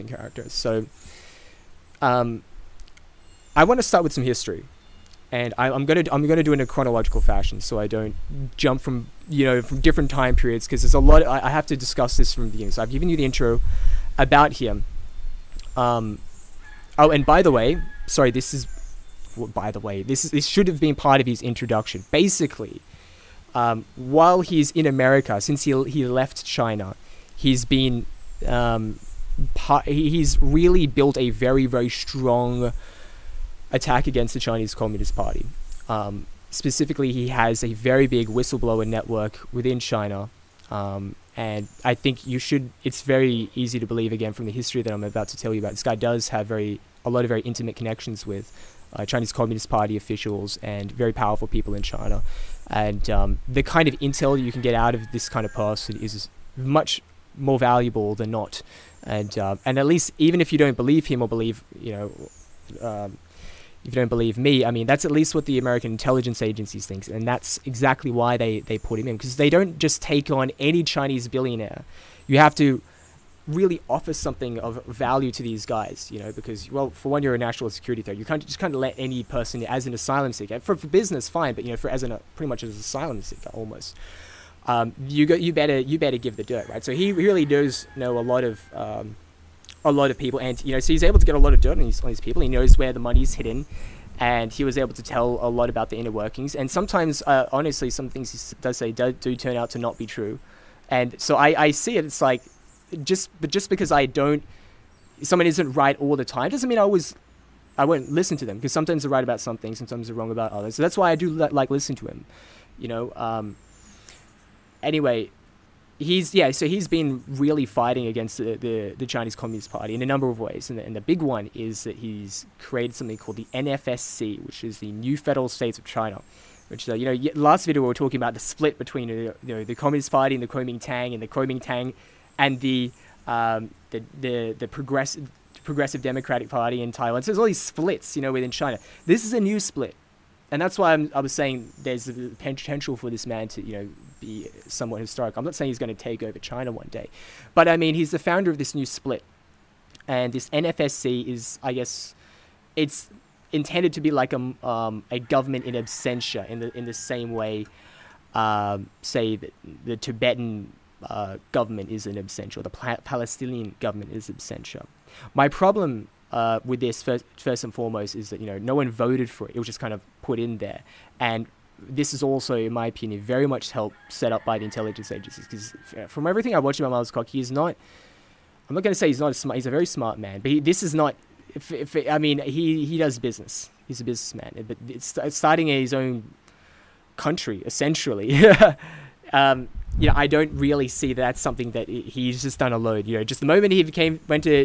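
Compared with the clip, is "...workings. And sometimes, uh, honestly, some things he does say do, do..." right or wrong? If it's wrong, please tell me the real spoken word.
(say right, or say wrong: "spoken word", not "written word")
right.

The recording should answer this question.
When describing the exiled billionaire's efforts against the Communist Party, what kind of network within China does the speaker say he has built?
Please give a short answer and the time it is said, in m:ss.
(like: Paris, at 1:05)
whistleblower network, at 0:38.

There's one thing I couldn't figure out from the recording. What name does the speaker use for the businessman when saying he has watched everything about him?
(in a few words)
Miles Kwok.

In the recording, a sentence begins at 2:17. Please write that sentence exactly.
So there's all these splits, you know, within China.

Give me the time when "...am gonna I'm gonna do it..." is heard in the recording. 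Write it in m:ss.
0:05.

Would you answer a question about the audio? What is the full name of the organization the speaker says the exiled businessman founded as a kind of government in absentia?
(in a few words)
New Federal States of China.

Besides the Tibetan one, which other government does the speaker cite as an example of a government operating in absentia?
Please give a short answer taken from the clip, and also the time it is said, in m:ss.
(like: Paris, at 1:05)
Palestinian, at 2:42.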